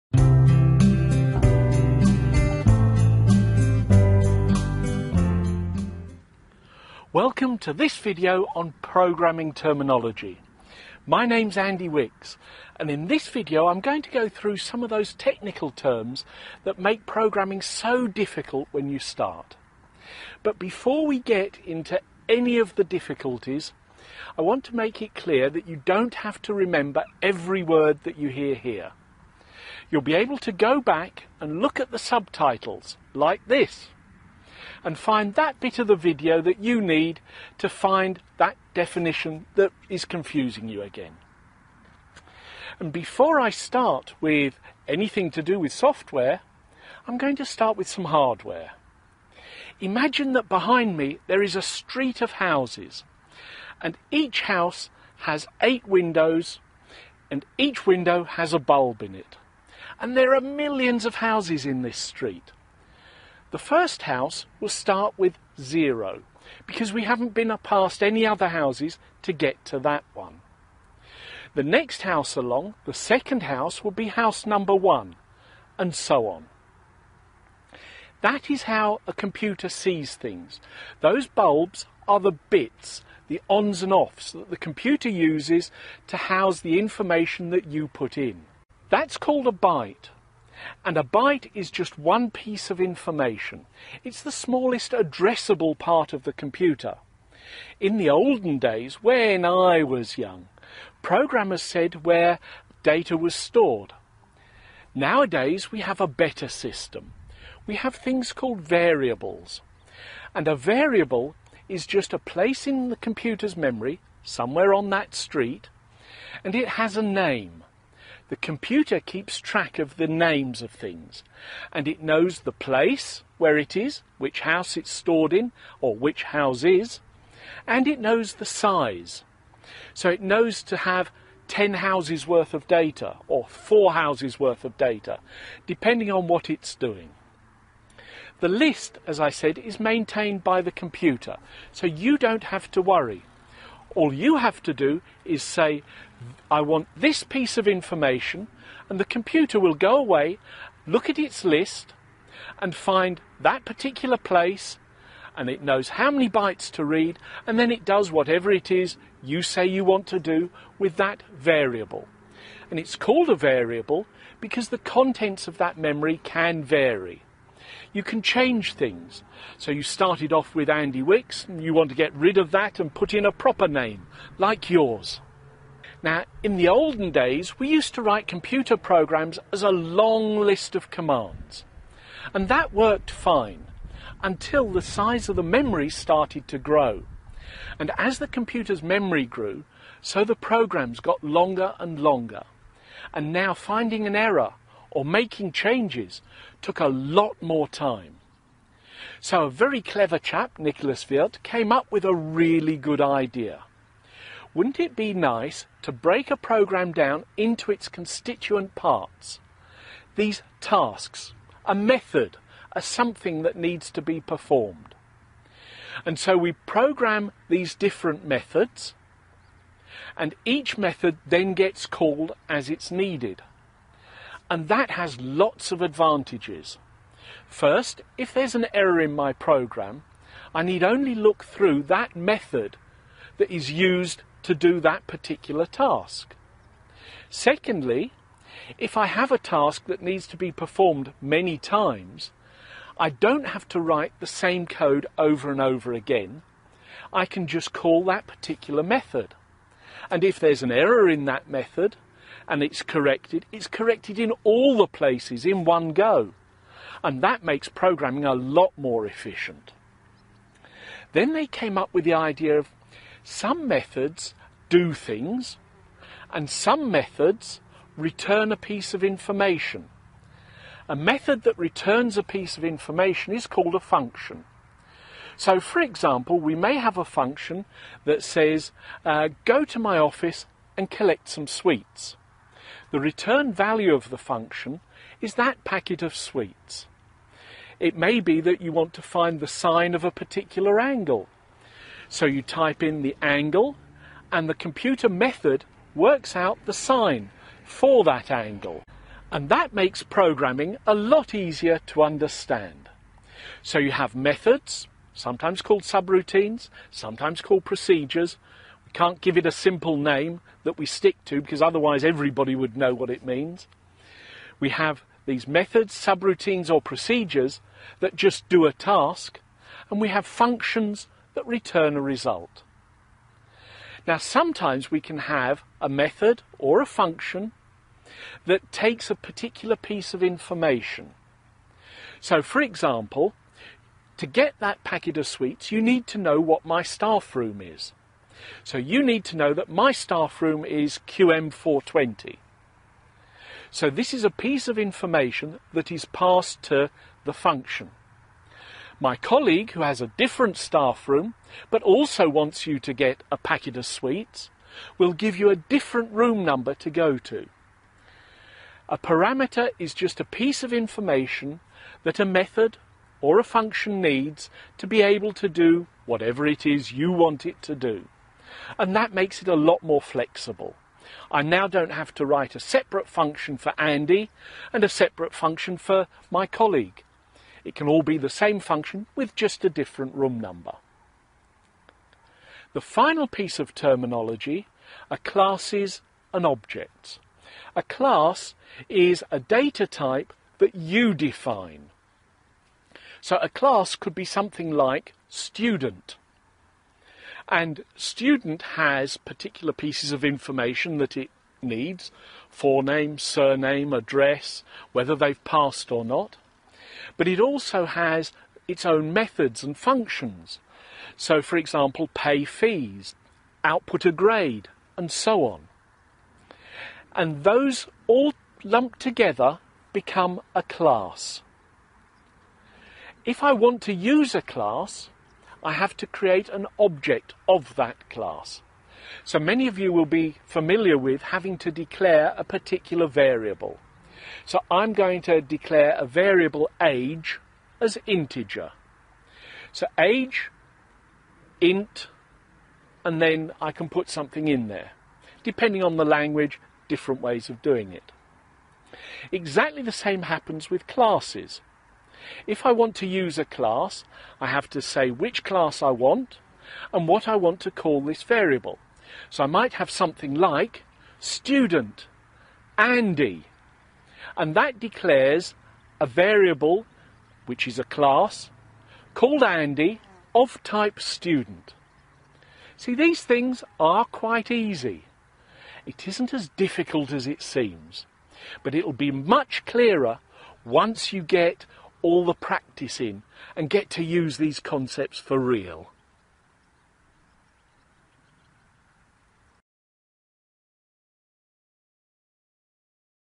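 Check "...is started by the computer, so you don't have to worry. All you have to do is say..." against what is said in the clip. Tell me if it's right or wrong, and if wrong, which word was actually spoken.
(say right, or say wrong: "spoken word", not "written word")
wrong: "maintained", not "started".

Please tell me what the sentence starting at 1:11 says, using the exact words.
The next house along, the second house, will be house number one, and so on.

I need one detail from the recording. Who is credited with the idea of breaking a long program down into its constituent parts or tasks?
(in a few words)
Nicholas Wirth.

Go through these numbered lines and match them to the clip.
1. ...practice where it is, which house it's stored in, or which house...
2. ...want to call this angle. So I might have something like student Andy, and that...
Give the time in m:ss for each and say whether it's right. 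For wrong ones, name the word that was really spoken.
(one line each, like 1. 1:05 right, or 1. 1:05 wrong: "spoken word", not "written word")
1. 2:02 wrong: "place", not "practice"
2. 7:37 wrong: "variable", not "angle".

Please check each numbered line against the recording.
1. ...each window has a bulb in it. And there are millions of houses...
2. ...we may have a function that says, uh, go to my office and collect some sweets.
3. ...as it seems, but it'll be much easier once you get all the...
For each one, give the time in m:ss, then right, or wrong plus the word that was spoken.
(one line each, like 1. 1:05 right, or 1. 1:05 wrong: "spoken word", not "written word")
1. 0:57 right
2. 4:36 right
3. 7:57 wrong: "clearer", not "easier".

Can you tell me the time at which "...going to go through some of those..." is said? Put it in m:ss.
0:13.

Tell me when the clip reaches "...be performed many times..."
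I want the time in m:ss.
4:00.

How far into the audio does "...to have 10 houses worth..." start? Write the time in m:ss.
2:10.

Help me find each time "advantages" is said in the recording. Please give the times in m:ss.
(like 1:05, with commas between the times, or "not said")
3:45.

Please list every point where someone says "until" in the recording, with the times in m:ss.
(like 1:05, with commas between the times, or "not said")
3:04.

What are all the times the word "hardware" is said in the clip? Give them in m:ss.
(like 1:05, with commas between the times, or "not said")
0:48.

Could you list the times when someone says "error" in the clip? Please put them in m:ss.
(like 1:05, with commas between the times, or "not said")
3:14, 3:48, 4:10.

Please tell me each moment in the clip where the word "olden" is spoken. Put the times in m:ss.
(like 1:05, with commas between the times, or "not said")
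1:38, 2:56.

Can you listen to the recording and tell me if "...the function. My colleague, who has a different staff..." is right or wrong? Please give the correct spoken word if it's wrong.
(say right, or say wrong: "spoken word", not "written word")
right.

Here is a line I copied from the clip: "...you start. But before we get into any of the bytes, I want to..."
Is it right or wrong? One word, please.
wrong.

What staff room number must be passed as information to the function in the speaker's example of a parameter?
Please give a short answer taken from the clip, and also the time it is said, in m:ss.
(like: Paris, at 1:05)
QM420, at 5:41.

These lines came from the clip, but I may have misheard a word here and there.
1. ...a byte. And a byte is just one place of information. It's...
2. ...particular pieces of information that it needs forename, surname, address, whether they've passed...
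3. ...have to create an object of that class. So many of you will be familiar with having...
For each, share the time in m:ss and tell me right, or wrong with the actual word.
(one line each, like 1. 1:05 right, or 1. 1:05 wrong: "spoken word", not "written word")
1. 1:29 wrong: "piece", not "place"
2. 6:39 right
3. 7:05 right.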